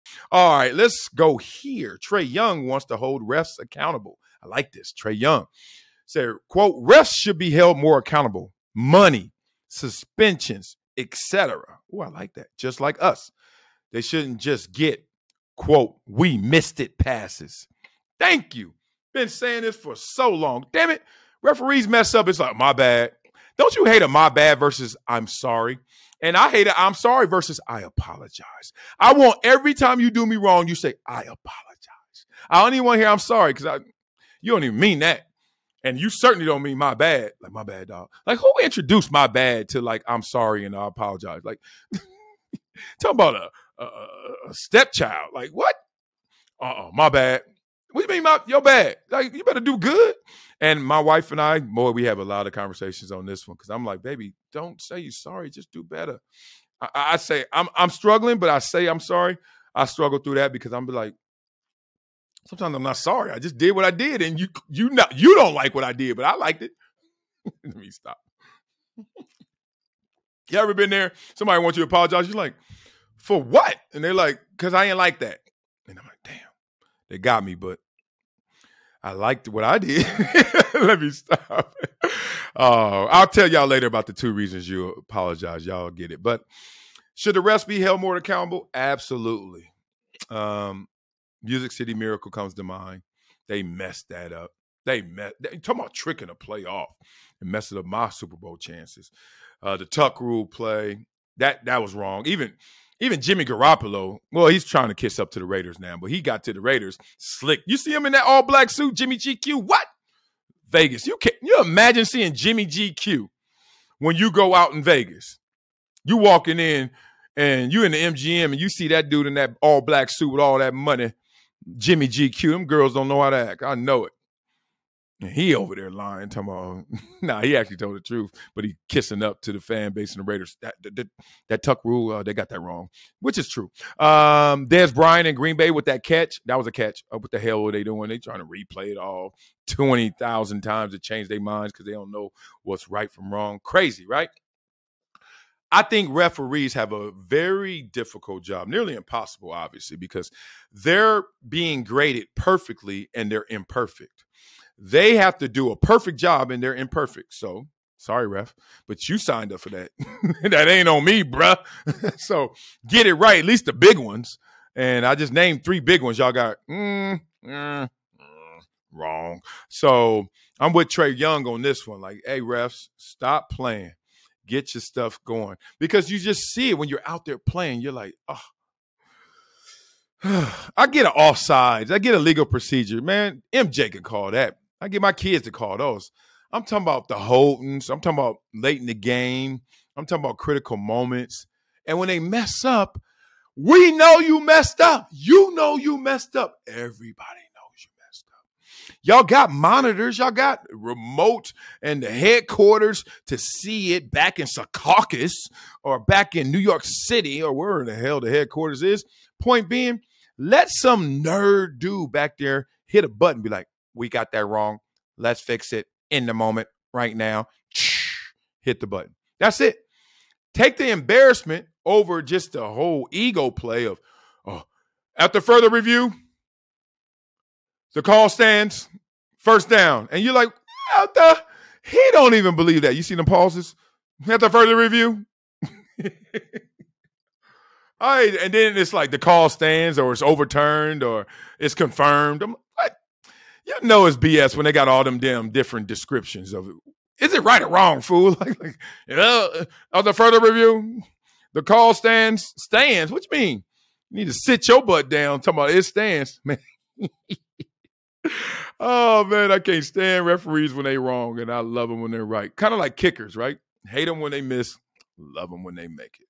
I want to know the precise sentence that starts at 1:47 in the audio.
You see him in that all black suit, Jimmy GQ.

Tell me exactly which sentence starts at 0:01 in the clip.
Trae Young wants to hold refs accountable.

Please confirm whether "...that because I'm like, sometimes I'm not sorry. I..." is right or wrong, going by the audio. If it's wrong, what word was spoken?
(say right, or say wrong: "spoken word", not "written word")
right.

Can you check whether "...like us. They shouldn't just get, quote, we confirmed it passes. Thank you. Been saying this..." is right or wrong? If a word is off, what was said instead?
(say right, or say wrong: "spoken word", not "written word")
wrong: "missed", not "confirmed".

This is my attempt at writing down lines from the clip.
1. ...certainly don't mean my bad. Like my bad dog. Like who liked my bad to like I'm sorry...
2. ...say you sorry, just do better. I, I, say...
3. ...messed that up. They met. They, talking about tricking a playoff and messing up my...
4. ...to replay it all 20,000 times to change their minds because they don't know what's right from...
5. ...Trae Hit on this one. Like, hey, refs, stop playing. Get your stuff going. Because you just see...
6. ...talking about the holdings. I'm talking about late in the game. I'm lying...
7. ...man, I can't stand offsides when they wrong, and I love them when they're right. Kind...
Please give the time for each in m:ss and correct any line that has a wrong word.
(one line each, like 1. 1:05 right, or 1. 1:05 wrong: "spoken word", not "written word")
1. 0:36 wrong: "introduced", not "liked"
2. 0:54 right
3. 1:33 right
4. 2:18 right
5. 2:50 wrong: "Young", not "Hit"
6. 3:06 wrong: "talking", not "lying"
7. 4:19 wrong: "referees", not "offsides".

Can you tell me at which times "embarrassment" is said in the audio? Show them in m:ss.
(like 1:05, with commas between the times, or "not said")
3:40.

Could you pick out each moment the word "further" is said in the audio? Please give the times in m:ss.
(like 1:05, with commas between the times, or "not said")
3:45, 3:54, 4:10.